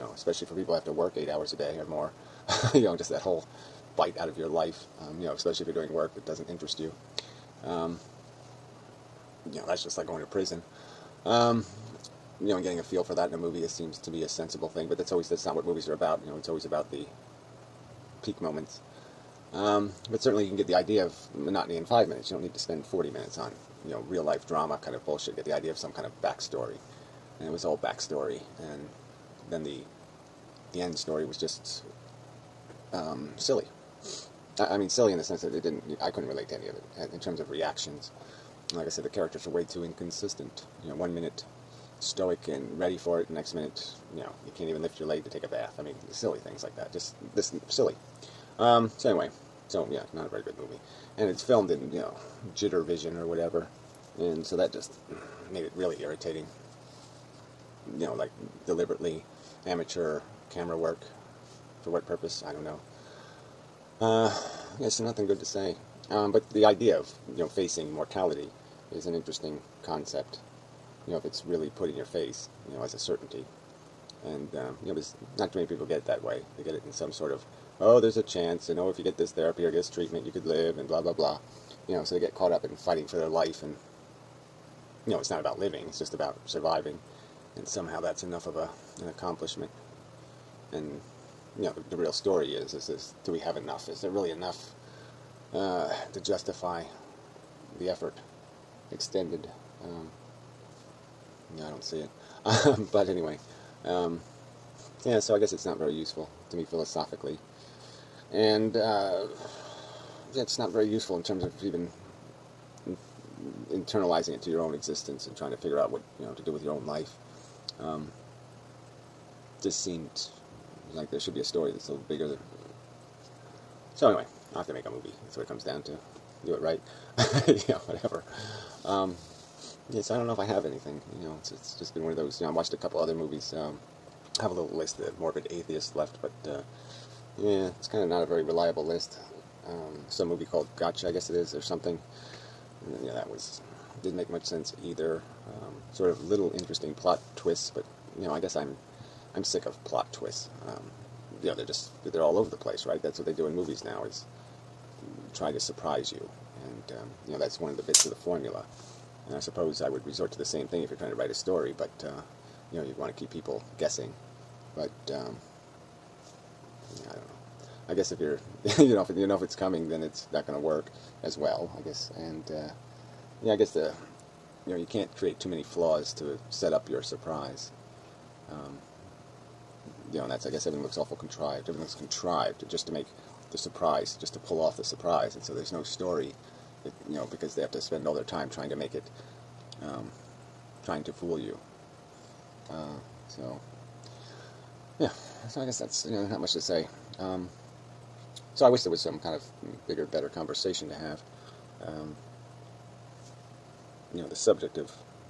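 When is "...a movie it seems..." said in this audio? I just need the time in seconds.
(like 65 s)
13 s.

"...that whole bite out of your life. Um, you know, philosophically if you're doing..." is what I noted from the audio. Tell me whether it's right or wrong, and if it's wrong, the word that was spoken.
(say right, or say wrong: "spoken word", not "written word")
wrong: "especially", not "philosophically".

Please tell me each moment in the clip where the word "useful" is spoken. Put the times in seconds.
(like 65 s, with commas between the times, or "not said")
105 s, 110 s.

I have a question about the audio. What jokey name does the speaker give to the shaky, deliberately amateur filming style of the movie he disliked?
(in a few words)
jitter vision.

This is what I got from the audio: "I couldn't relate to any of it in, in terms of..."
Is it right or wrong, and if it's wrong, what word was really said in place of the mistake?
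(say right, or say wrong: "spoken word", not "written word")
right.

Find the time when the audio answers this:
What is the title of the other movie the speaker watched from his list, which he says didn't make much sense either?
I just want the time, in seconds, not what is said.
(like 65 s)
140 s.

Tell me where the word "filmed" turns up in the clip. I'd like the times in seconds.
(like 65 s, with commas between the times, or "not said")
51 s.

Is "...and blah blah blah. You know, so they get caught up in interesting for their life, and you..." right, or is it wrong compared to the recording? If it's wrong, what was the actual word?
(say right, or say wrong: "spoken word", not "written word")
wrong: "fighting", not "interesting".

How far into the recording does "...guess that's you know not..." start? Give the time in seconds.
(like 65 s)
195 s.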